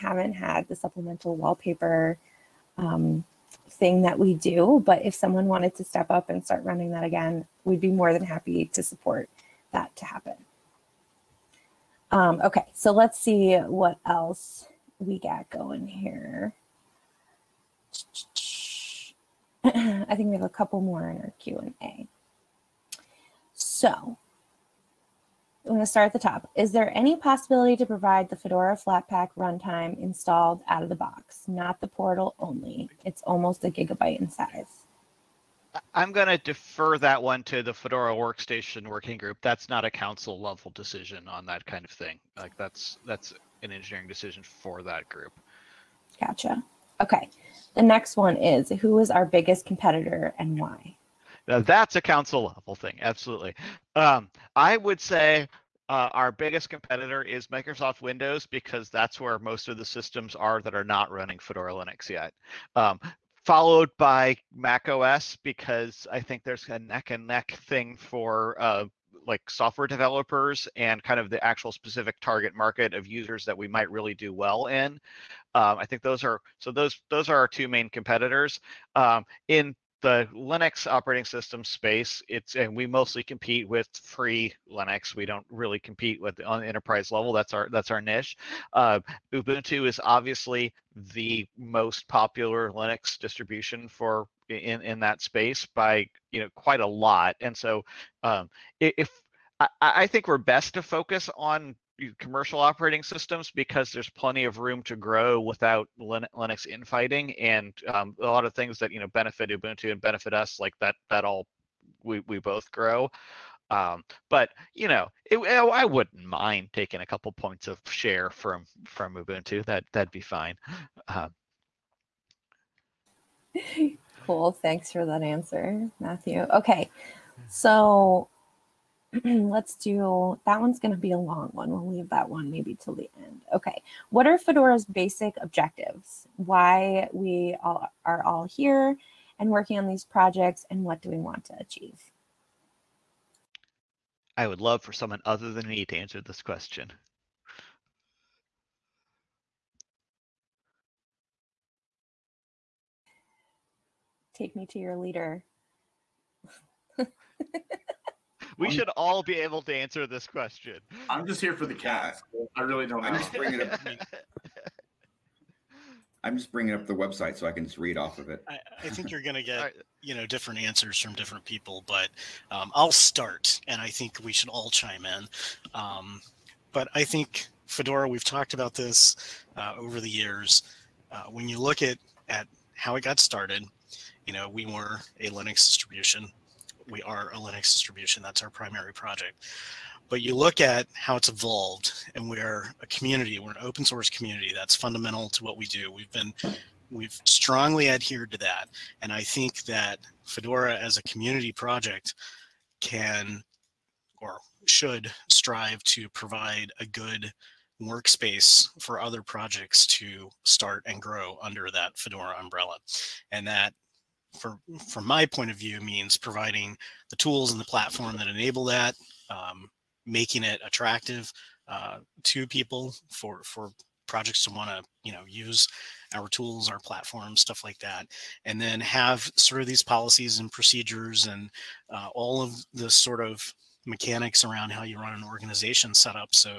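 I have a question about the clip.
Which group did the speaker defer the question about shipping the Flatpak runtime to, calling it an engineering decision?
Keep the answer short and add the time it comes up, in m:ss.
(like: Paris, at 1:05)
Fedora Workstation Working Group, at 0:37.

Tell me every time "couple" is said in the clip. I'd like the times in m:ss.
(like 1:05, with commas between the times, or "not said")
0:20, 1:57.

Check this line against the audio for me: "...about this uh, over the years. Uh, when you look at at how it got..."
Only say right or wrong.
right.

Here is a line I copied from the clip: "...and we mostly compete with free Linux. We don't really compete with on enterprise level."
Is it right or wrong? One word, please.
right.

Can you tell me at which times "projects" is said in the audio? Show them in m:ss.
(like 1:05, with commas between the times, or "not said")
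2:20, 3:08, 3:21, 3:29, 3:44.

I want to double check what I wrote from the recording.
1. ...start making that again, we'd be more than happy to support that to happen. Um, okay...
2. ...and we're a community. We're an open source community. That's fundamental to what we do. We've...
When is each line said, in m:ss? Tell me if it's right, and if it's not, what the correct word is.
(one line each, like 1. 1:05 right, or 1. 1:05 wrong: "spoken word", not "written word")
1. 0:06 wrong: "running", not "making"
2. 3:12 right.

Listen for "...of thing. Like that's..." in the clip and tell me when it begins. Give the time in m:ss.
0:41.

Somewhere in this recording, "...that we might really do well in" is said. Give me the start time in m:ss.
1:13.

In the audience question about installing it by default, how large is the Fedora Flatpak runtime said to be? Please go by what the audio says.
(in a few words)
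almost a gigabyte.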